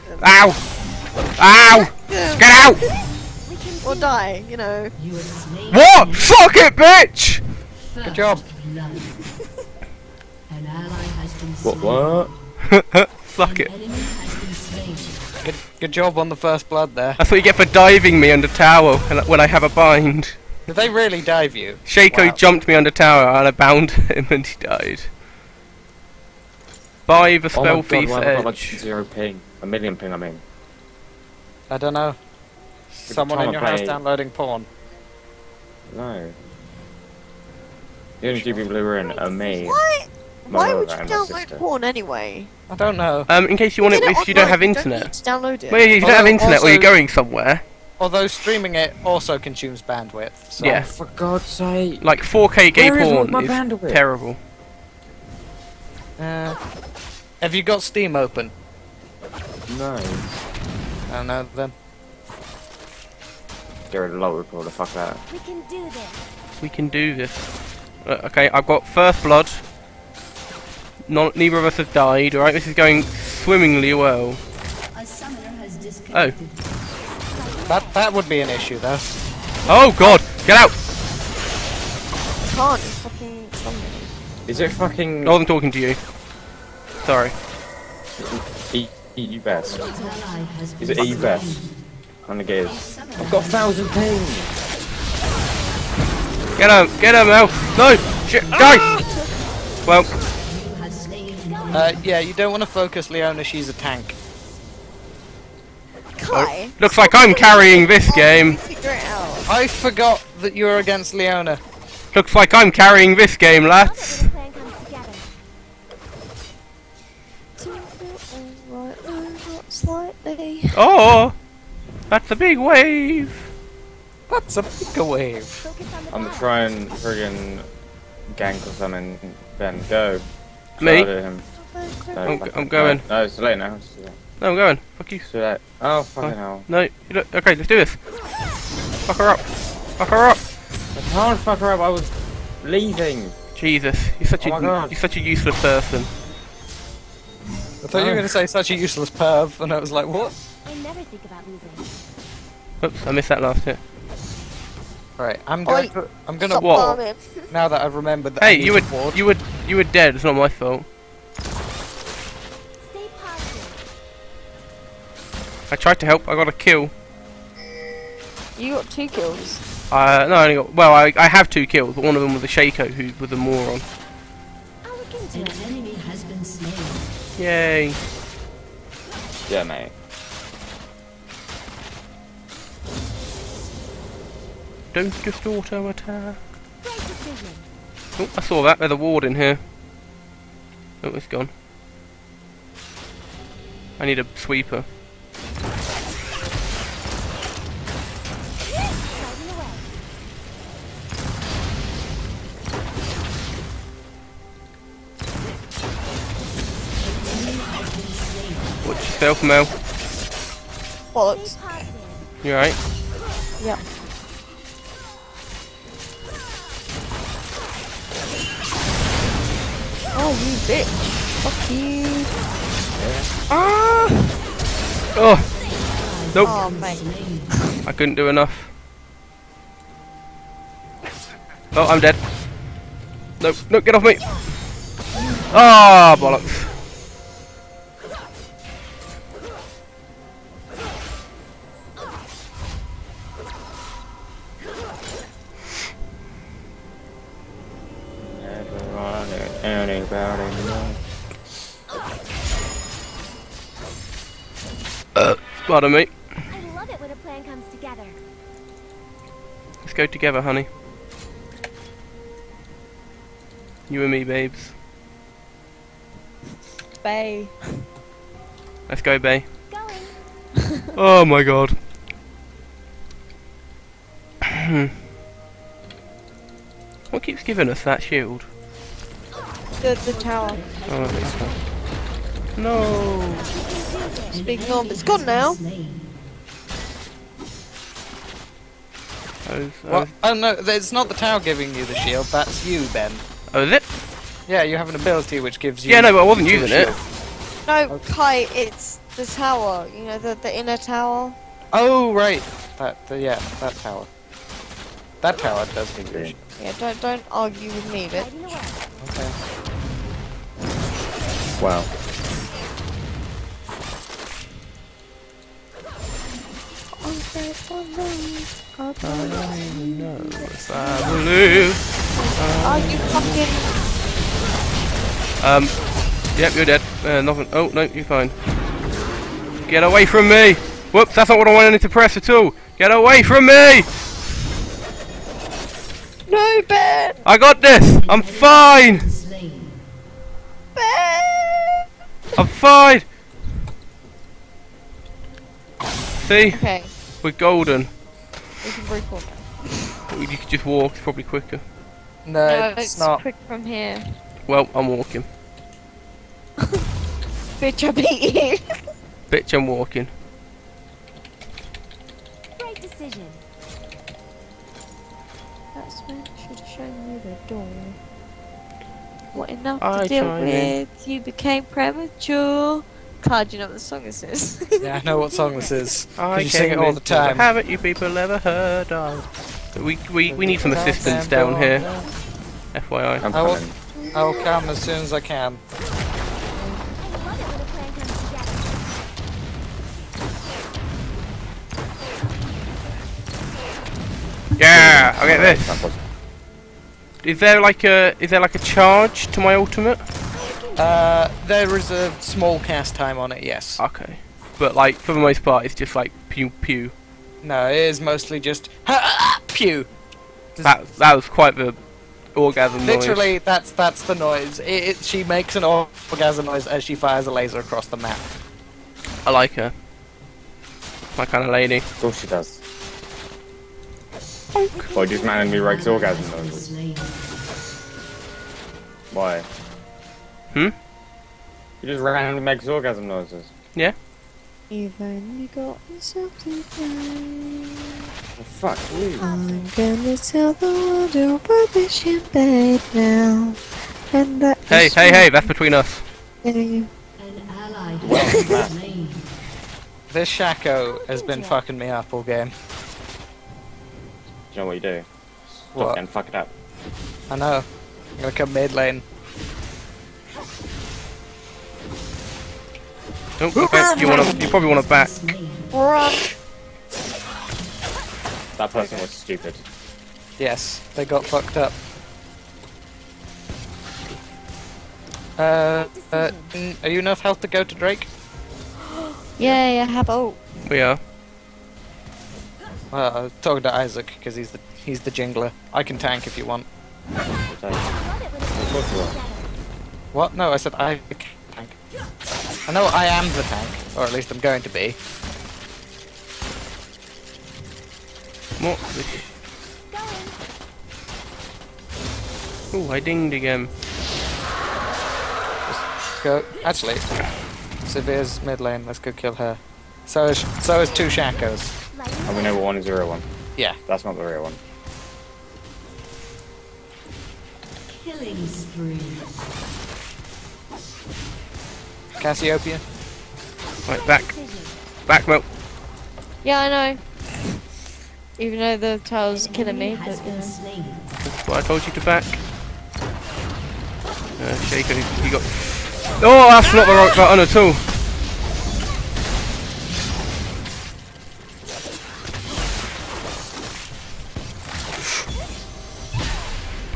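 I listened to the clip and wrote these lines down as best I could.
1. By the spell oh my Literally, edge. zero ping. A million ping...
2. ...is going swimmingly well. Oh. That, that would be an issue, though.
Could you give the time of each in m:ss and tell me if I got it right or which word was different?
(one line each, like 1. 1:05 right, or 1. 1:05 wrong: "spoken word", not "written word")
1. 0:27 wrong: "God", not "Literally"
2. 1:12 right.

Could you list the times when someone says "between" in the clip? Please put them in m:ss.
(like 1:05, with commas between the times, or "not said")
7:25.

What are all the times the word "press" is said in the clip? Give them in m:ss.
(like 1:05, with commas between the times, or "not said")
5:31.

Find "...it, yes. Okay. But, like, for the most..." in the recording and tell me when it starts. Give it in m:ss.
6:43.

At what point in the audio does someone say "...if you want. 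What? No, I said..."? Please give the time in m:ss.
8:06.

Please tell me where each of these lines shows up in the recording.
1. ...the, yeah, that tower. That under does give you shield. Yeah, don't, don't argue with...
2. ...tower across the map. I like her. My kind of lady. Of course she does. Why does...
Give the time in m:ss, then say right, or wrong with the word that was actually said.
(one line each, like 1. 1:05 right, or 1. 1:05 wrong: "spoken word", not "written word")
1. 5:03 wrong: "tower", not "under"
2. 6:57 wrong: "laser", not "tower".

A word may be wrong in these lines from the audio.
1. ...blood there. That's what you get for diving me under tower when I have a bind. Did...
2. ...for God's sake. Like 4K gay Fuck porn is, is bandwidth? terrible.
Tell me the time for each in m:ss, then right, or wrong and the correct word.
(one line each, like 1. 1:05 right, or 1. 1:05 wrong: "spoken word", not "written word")
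1. 0:16 right
2. 0:50 wrong: "Where", not "Fuck".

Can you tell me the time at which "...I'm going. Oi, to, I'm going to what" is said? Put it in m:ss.
2:35.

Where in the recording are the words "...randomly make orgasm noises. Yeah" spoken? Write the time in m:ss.
7:12.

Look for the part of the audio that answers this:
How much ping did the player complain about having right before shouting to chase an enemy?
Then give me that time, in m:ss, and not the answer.
1:33.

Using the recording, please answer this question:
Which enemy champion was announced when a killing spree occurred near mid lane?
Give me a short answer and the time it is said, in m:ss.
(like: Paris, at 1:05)
Cassiopeia, at 8:42.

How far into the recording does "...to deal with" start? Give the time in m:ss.
6:10.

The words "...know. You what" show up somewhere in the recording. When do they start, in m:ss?
0:04.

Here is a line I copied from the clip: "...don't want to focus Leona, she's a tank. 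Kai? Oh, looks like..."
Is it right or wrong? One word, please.
right.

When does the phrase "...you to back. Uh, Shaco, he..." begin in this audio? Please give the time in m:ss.
8:51.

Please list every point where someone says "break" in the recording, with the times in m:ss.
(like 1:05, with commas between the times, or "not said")
5:48.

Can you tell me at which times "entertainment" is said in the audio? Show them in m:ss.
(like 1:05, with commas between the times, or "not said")
not said.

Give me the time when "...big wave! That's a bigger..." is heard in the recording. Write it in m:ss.
2:02.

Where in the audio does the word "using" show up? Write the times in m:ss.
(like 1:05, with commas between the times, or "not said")
4:56.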